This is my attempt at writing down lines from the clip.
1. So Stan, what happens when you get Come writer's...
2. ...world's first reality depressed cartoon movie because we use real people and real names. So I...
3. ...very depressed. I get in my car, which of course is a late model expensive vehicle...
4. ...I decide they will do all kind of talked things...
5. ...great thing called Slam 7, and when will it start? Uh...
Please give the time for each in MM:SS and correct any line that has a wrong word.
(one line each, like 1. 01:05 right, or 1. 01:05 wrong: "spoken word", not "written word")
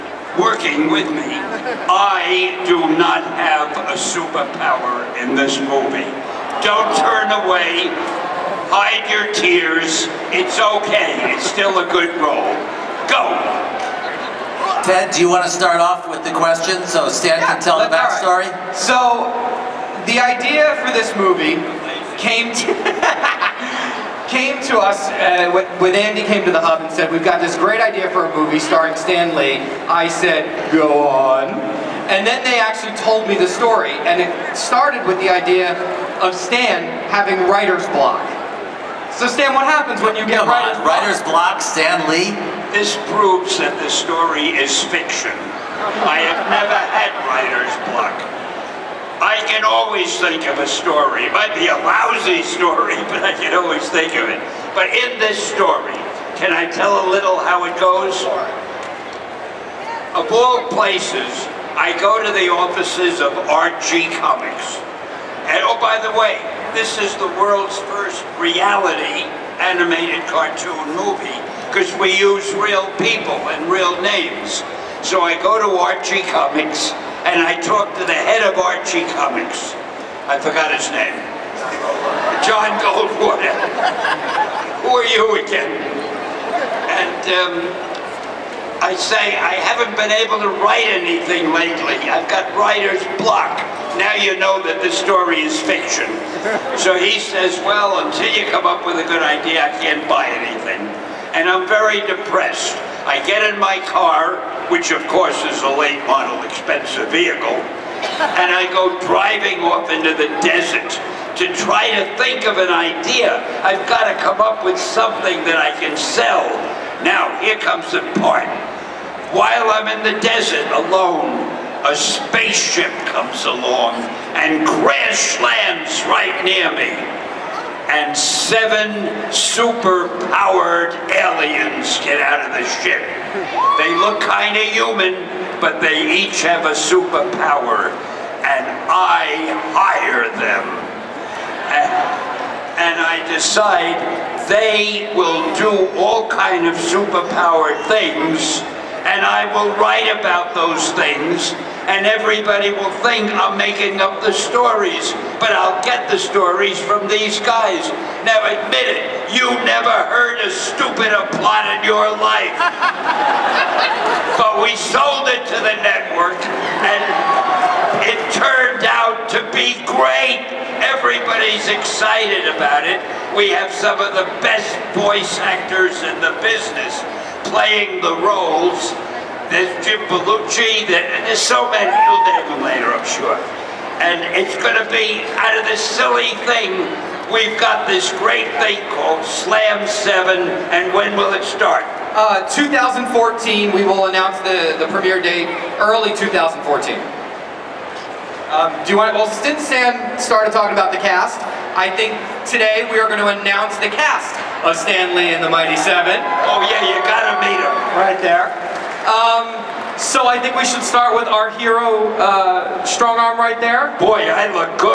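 1. 00:39 right
2. 01:07 wrong: "animated", not "depressed"
3. 01:41 right
4. 02:23 wrong: "superpowered", not "talked"
5. 03:08 right.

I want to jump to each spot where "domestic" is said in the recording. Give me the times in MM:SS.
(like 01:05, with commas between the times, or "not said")
not said.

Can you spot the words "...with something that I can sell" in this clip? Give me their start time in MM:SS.
01:54.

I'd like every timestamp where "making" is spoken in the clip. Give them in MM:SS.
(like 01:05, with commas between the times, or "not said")
02:33.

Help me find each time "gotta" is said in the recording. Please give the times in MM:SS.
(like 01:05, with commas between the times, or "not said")
03:27.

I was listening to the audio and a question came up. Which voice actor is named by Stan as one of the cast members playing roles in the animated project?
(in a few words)
Jim Belushi.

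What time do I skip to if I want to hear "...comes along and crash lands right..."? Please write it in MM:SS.
02:03.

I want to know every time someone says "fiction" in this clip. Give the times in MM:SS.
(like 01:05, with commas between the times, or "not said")
00:44, 01:35.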